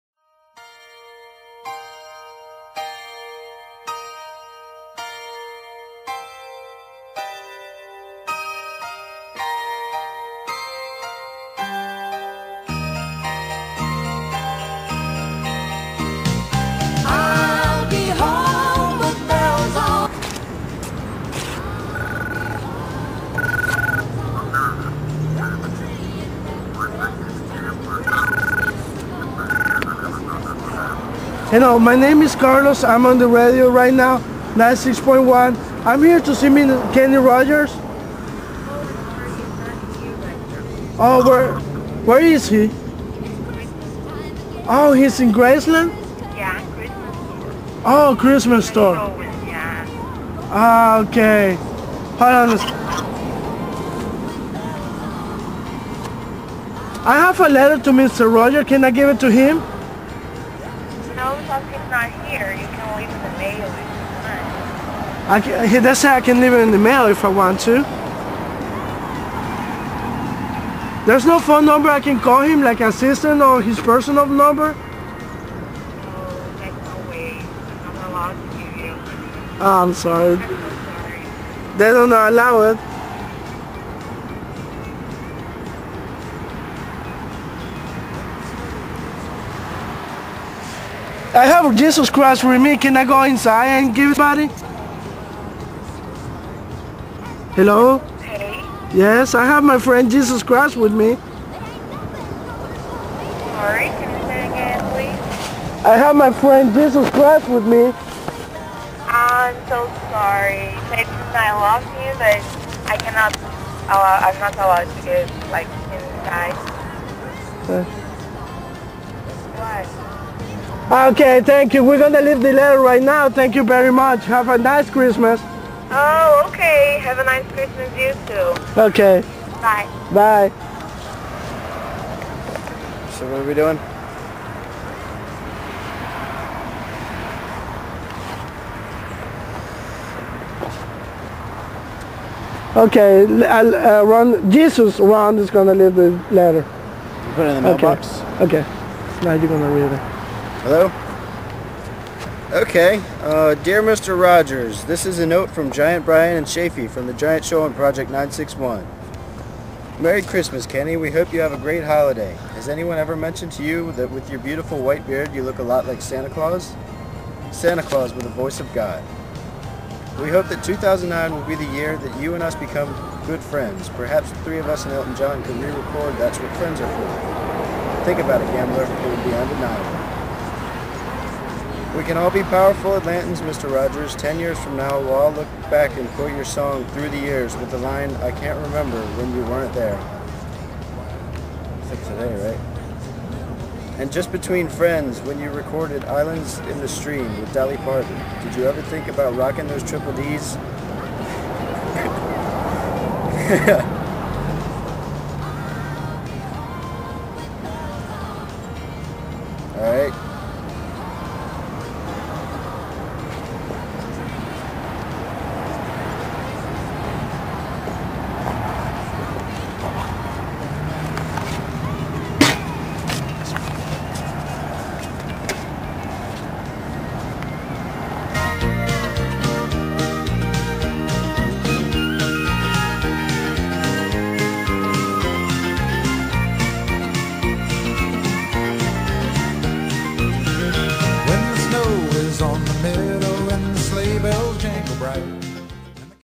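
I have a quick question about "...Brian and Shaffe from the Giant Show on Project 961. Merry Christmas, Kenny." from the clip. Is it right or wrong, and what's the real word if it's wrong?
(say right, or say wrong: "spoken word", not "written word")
right.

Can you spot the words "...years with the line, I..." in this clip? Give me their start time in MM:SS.
03:07.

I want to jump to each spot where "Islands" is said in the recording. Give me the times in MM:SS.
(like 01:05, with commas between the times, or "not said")
03:16.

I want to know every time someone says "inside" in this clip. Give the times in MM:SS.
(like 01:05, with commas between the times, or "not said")
01:33, 01:55.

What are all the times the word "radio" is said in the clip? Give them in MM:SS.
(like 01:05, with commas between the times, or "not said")
00:33.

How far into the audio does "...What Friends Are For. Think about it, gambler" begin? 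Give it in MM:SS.
02:56.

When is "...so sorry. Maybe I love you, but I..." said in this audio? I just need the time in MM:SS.
01:49.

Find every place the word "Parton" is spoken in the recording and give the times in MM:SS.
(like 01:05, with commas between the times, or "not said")
03:17.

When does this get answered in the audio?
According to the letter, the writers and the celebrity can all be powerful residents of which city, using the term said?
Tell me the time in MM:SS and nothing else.
03:02.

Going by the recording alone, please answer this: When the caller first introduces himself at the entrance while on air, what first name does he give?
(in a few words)
Carlos.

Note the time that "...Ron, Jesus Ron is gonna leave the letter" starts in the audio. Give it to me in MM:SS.
02:24.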